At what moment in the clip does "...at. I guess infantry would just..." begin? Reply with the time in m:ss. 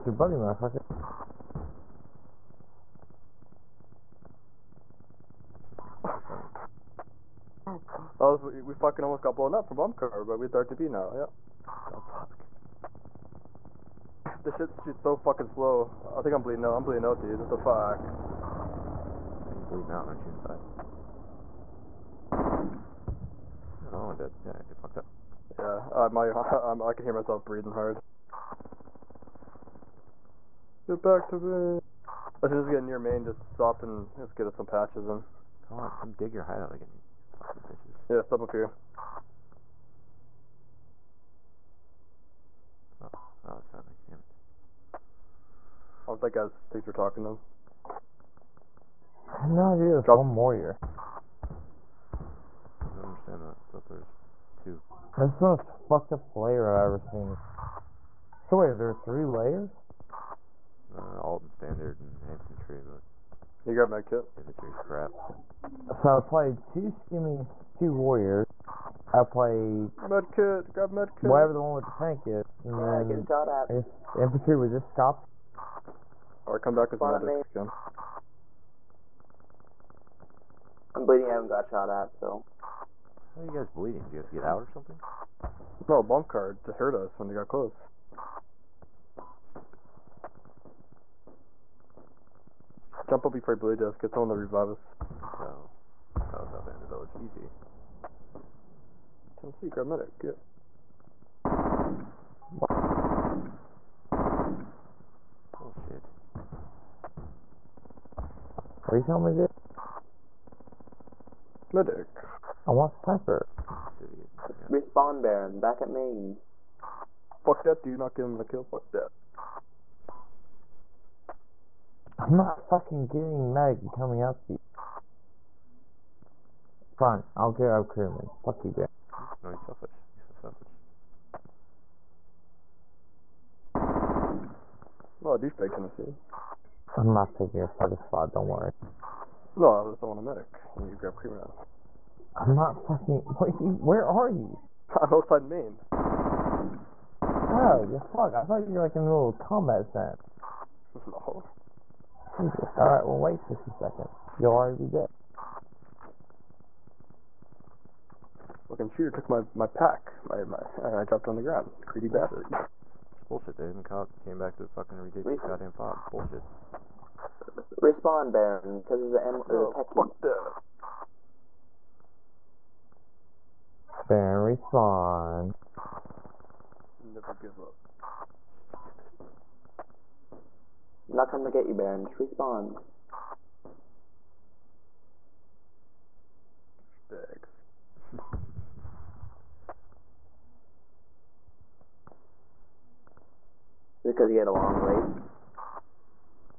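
1:13.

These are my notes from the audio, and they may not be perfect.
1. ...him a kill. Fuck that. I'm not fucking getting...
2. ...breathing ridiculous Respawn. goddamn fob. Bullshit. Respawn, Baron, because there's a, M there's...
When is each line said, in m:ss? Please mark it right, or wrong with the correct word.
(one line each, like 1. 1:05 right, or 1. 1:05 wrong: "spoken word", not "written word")
1. 1:58 right
2. 2:44 wrong: "fucking", not "breathing".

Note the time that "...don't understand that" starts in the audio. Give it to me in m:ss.
0:52.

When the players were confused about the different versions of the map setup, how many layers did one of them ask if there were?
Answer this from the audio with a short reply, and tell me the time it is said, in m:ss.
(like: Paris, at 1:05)
3, at 0:59.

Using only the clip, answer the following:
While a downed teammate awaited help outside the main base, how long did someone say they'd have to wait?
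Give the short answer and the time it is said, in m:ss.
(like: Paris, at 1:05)
60 seconds, at 2:33.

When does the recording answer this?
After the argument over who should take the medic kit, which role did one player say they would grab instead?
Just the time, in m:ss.
2:07.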